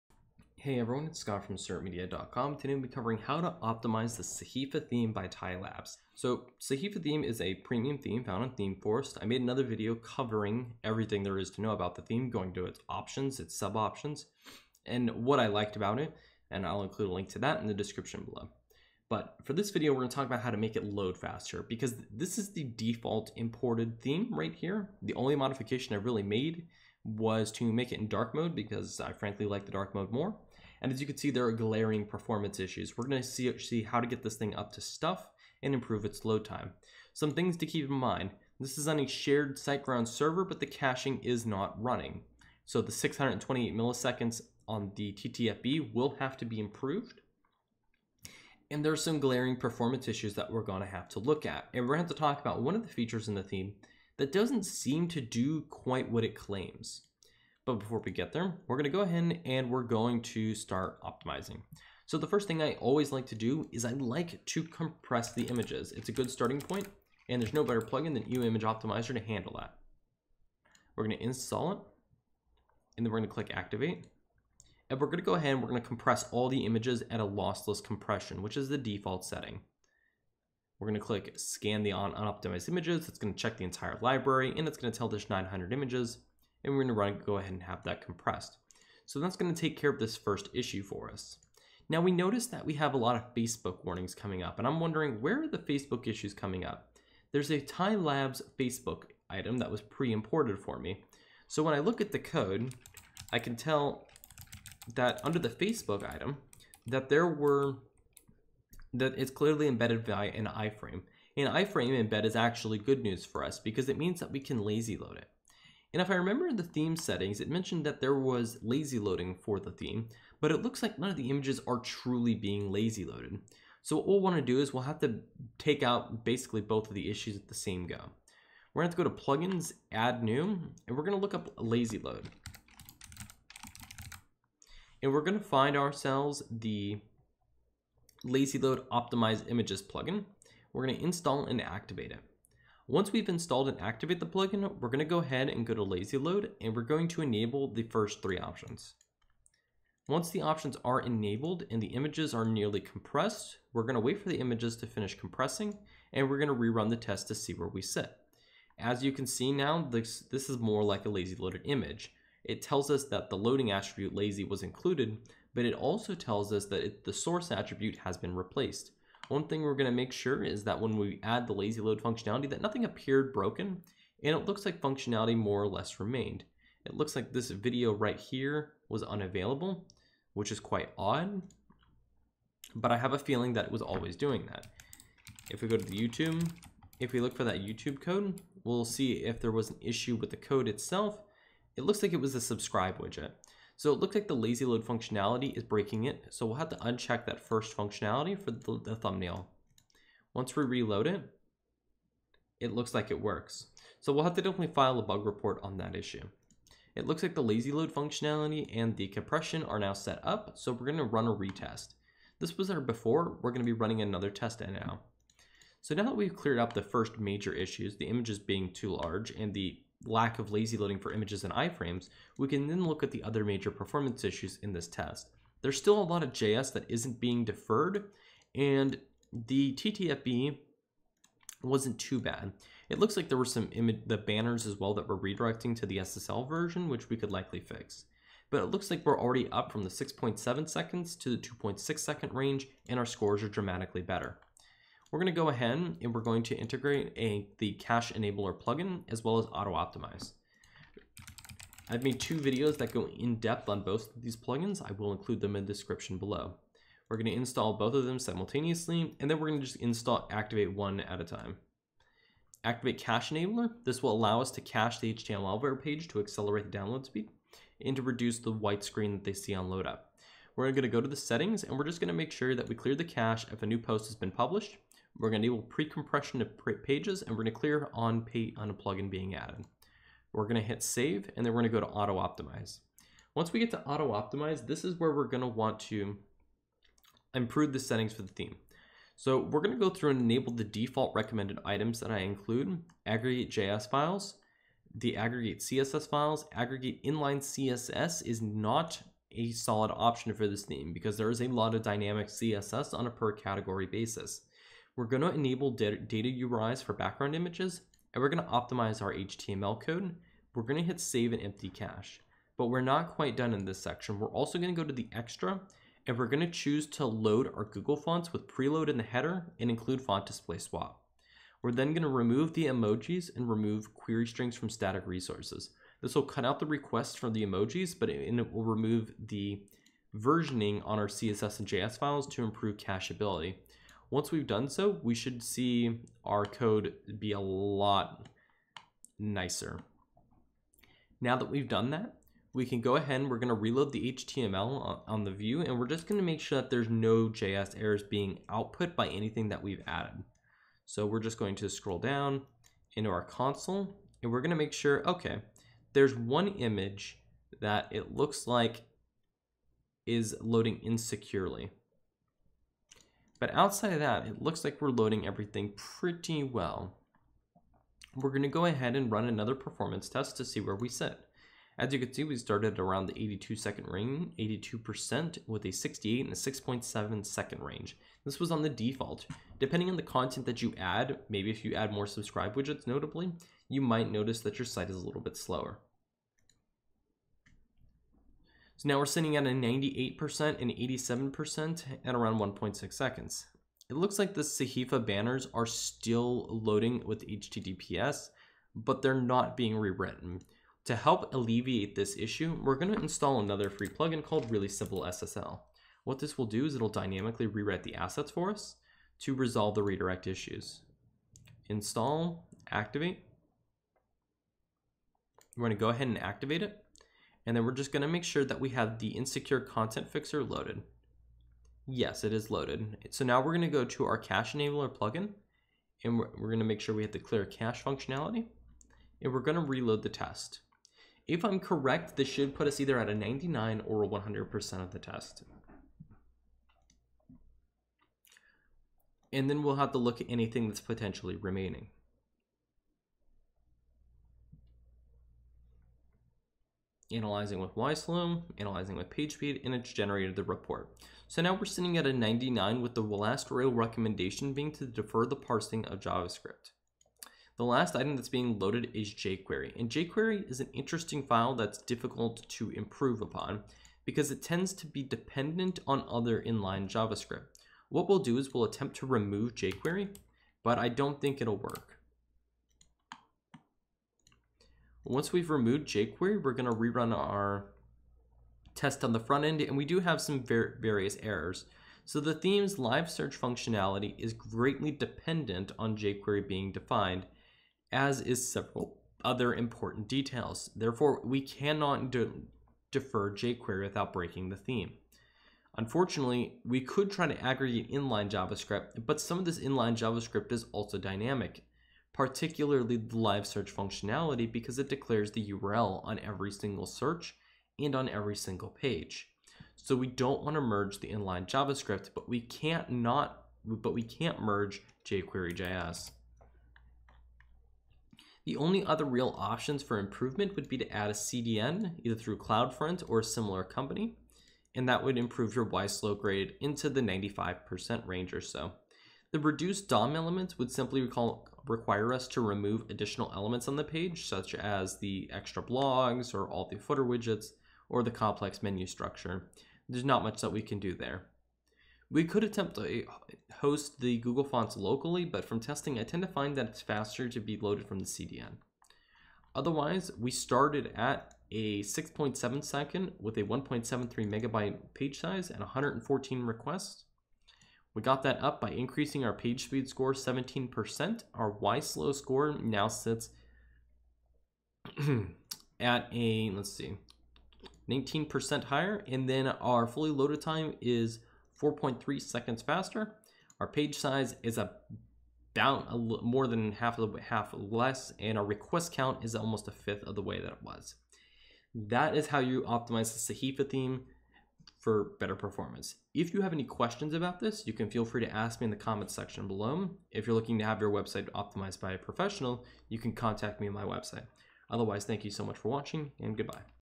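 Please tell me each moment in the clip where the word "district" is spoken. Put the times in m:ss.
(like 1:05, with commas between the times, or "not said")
not said.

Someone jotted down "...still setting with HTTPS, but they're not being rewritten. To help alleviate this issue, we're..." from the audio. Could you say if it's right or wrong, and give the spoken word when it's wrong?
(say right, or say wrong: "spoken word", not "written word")
wrong: "loading", not "setting".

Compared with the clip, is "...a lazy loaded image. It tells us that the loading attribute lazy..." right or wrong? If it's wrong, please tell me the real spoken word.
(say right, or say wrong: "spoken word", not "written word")
right.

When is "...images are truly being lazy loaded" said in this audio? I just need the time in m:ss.
2:01.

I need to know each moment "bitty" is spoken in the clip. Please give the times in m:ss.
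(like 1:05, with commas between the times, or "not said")
not said.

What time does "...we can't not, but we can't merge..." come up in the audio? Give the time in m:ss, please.
8:32.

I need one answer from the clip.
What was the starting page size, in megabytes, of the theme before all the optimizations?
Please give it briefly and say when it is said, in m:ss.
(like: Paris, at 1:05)
1.73 megabytes, at 9:13.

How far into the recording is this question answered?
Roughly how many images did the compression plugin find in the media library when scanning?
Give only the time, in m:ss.
1:25.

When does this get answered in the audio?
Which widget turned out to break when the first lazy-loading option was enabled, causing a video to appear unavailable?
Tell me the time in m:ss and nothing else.
3:12.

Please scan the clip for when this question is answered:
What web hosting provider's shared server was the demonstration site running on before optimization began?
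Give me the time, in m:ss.
0:39.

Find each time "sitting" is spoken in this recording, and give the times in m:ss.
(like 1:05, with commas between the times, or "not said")
6:29, 7:31.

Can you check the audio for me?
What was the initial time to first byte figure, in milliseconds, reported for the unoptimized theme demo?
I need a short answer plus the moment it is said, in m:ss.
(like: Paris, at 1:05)
628, at 0:42.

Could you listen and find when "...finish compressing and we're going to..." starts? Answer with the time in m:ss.
2:34.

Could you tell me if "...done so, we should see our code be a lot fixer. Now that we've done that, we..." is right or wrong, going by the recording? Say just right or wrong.
wrong.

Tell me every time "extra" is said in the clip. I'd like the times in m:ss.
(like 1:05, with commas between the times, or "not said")
5:15, 8:55.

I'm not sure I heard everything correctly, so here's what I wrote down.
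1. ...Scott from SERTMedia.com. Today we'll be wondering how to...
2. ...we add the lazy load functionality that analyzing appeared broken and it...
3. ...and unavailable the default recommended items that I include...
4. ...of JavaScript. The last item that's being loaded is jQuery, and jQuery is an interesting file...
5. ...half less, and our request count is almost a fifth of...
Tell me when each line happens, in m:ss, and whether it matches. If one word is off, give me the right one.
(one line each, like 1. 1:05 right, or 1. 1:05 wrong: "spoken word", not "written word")
1. 0:01 wrong: "covering", not "wondering"
2. 2:50 wrong: "nothing", not "analyzing"
3. 4:50 wrong: "enable", not "unavailable"
4. 7:35 right
5. 9:37 right.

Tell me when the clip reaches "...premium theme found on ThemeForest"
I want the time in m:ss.
0:07.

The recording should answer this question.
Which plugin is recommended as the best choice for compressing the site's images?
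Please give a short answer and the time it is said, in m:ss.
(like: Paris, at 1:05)
EWWW Image Optimizer, at 1:08.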